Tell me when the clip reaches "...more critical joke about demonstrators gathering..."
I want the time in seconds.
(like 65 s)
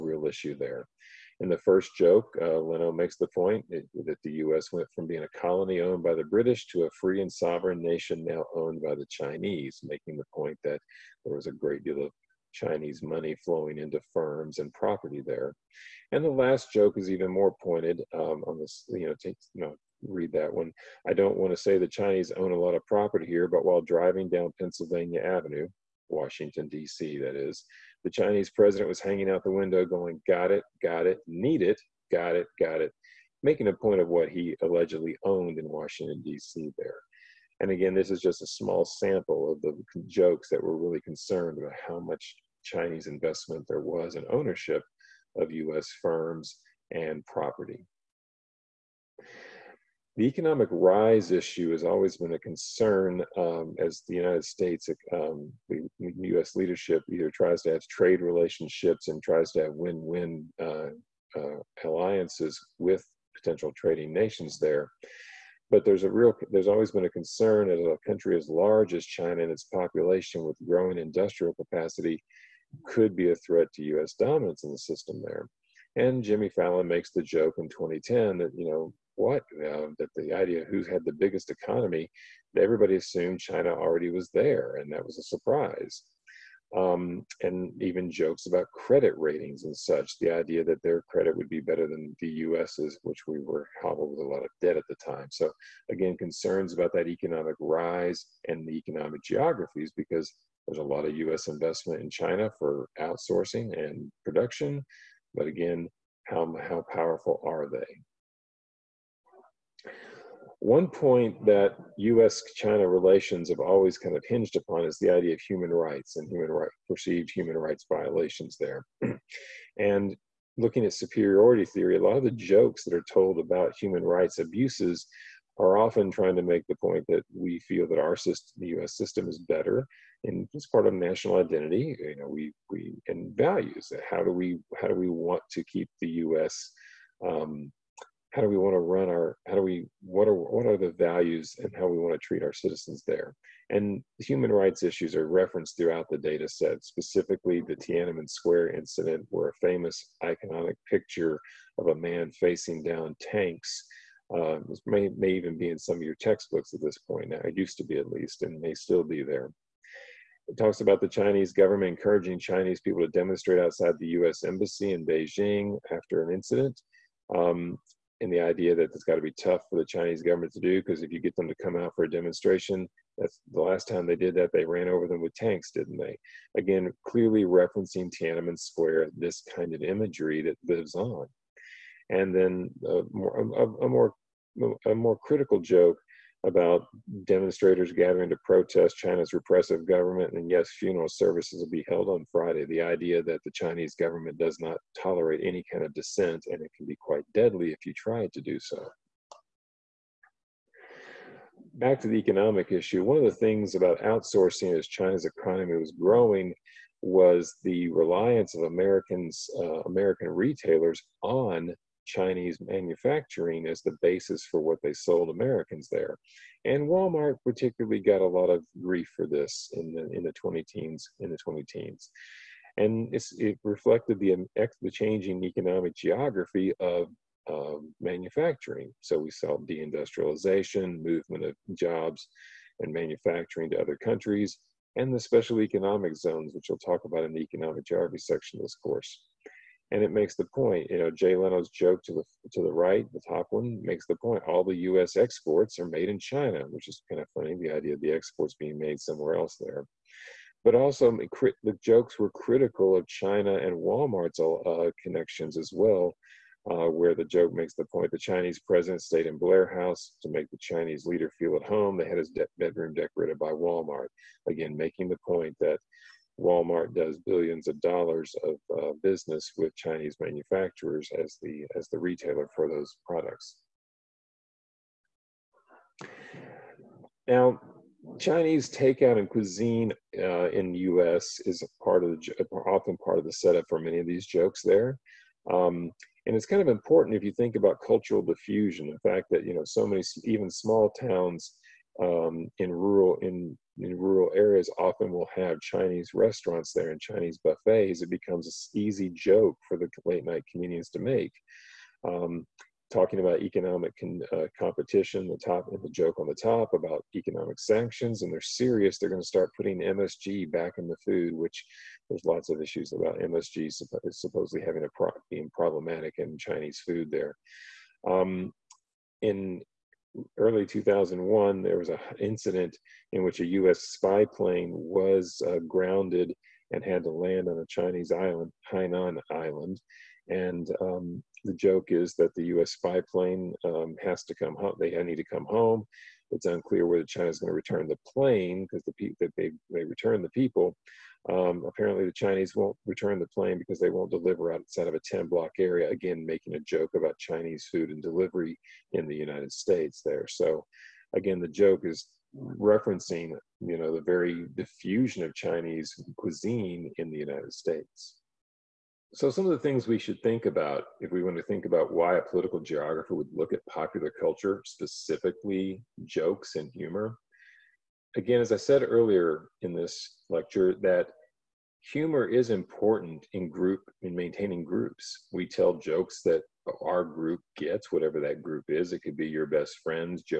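184 s.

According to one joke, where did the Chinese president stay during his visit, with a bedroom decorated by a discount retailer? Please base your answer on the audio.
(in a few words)
Blair House.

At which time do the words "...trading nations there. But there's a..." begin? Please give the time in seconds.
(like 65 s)
63 s.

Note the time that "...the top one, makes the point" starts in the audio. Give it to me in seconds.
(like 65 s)
243 s.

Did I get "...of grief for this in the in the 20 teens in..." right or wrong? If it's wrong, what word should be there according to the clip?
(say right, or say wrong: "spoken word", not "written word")
right.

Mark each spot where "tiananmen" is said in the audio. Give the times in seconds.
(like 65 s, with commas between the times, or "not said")
147 s, 178 s.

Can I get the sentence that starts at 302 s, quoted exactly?
Um, talking about economic con, uh, competition, the top and the joke on the top about economic sanctions, and they're serious.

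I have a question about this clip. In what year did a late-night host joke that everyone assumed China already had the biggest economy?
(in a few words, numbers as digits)
2010.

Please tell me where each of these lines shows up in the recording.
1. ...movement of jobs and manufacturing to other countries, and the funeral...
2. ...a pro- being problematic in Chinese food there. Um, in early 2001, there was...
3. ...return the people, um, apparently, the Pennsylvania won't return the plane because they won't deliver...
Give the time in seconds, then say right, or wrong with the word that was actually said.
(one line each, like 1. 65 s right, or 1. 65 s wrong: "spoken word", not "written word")
1. 231 s wrong: "special", not "funeral"
2. 314 s right
3. 339 s wrong: "Chinese", not "Pennsylvania".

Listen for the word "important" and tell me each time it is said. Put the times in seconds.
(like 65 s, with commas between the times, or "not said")
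286 s, 372 s.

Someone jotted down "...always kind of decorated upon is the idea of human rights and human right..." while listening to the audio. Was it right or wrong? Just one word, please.
wrong.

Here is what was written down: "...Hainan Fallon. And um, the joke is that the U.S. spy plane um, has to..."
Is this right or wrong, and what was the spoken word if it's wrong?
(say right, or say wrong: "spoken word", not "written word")
wrong: "Island", not "Fallon".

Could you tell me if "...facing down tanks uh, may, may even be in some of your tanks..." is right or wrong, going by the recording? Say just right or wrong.
wrong.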